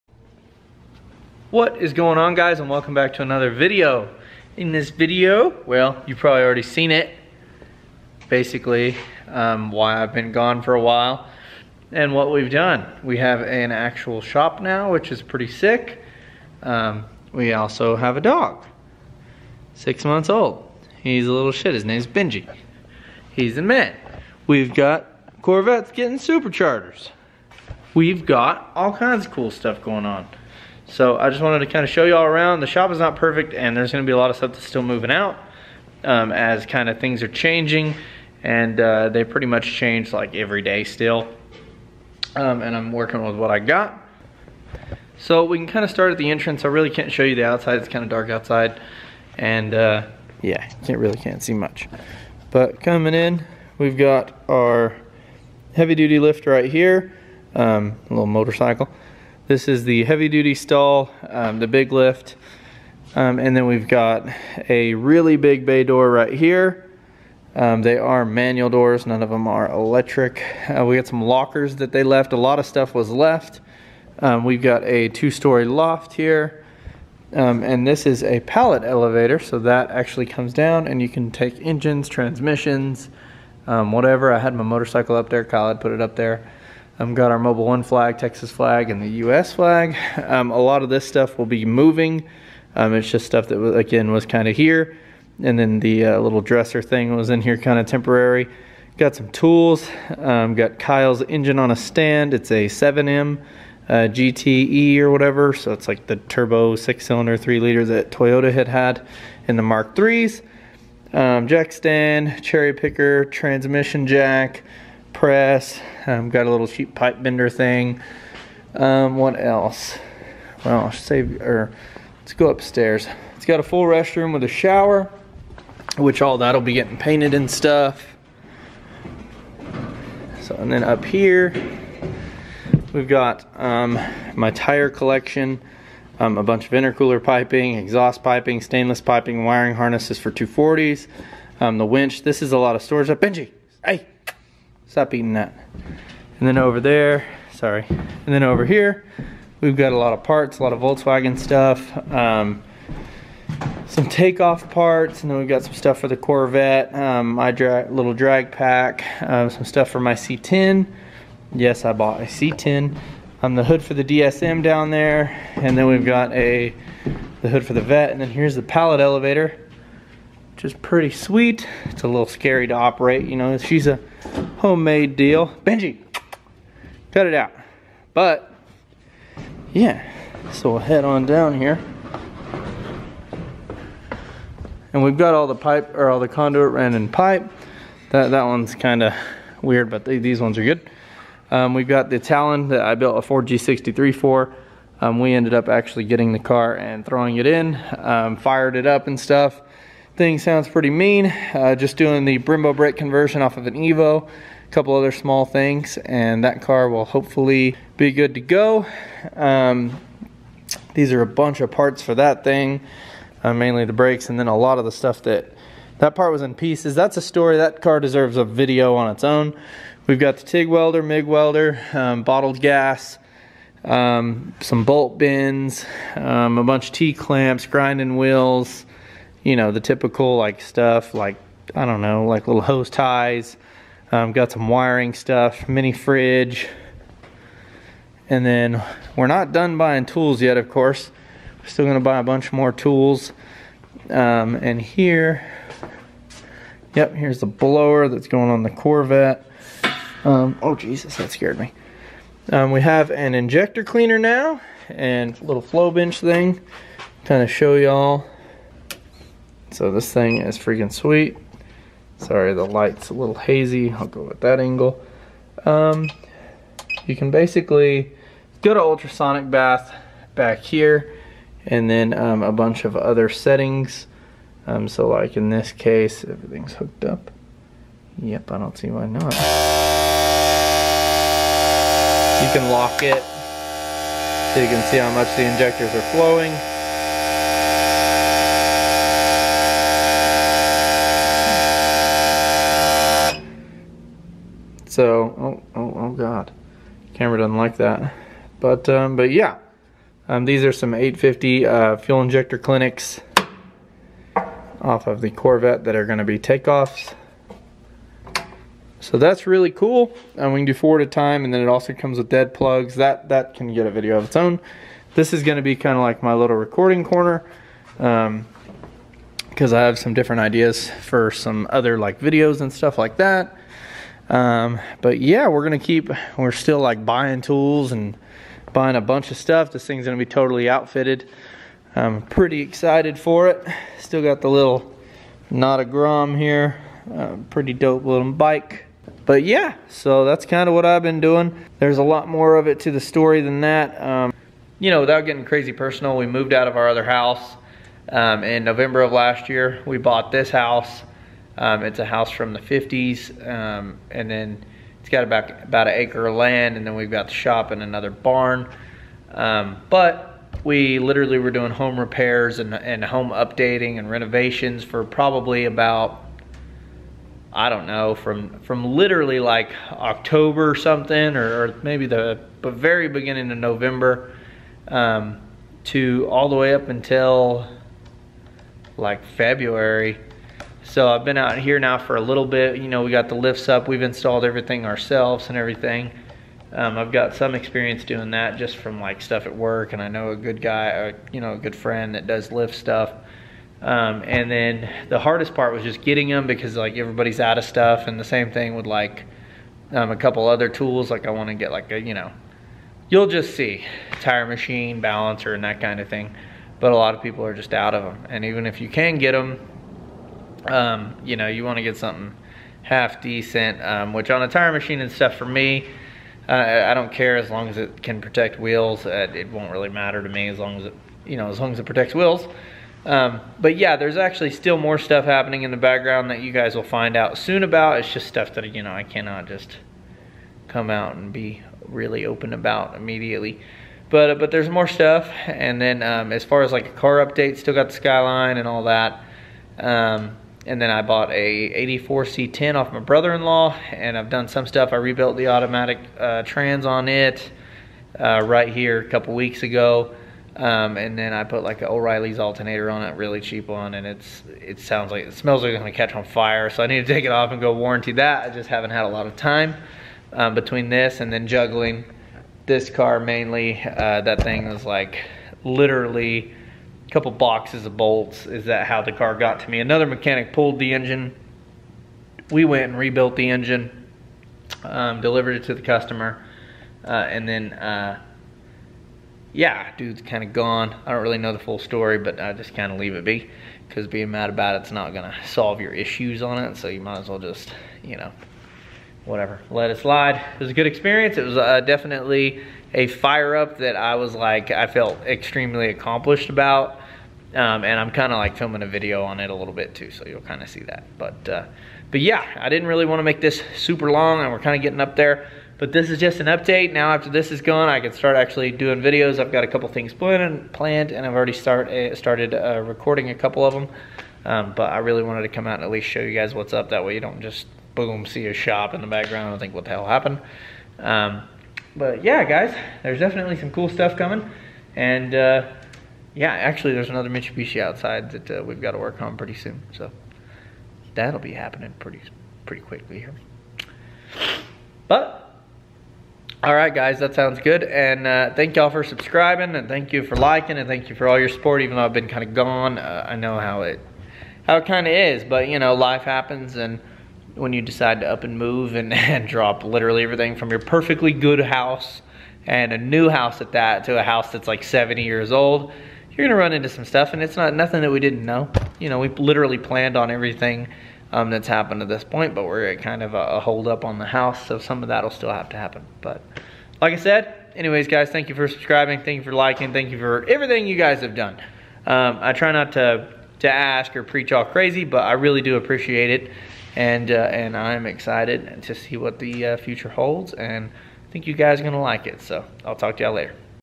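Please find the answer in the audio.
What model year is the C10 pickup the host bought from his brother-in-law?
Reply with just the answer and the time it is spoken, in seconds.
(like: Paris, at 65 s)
84, at 441 s.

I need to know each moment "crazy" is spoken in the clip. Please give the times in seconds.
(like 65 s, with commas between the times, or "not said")
345 s, 574 s.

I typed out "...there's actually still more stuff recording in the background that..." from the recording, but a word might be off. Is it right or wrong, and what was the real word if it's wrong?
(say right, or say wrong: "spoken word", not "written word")
wrong: "happening", not "recording".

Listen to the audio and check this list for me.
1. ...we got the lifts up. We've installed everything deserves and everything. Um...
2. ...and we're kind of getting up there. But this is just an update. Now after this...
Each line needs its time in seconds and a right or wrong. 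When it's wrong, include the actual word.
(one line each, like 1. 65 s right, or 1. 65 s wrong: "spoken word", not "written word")
1. 383 s wrong: "ourselves", not "deserves"
2. 504 s right.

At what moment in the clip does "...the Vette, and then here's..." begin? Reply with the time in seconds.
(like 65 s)
167 s.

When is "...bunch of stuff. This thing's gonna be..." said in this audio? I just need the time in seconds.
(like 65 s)
329 s.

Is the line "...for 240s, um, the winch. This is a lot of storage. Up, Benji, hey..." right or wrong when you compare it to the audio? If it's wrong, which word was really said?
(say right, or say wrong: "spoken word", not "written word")
right.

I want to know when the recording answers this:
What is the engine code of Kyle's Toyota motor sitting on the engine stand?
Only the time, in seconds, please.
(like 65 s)
102 s.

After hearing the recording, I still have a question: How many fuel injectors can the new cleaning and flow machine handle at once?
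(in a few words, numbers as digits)
4.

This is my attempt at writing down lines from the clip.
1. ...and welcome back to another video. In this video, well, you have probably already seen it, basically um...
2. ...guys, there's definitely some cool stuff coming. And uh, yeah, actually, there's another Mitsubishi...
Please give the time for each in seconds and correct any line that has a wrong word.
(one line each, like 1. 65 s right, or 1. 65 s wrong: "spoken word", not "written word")
1. 2 s right
2. 522 s right.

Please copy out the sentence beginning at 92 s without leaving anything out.
Um, it's just stuff that, again, was kind of here.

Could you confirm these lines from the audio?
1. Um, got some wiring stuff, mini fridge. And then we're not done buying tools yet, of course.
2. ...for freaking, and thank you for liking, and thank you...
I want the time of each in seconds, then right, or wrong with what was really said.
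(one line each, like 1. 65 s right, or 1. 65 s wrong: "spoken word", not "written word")
1. 234 s right
2. 538 s wrong: "subscribing", not "freaking".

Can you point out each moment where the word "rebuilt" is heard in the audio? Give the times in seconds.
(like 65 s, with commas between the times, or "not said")
444 s, 472 s.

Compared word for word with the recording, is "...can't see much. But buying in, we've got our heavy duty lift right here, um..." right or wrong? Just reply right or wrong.
wrong.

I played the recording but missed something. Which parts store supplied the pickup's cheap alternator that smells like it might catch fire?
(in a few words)
O'Reilly's.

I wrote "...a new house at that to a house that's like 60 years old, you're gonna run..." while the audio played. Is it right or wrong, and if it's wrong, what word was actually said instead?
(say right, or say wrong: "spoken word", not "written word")
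wrong: "70", not "60".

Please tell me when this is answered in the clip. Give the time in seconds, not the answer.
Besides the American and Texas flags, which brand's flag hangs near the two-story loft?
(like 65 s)
87 s.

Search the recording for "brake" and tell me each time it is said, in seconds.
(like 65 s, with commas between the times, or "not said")
202 s, 213 s.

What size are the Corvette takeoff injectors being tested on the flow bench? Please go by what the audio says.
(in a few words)
850.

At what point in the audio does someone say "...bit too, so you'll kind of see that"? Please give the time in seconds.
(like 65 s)
499 s.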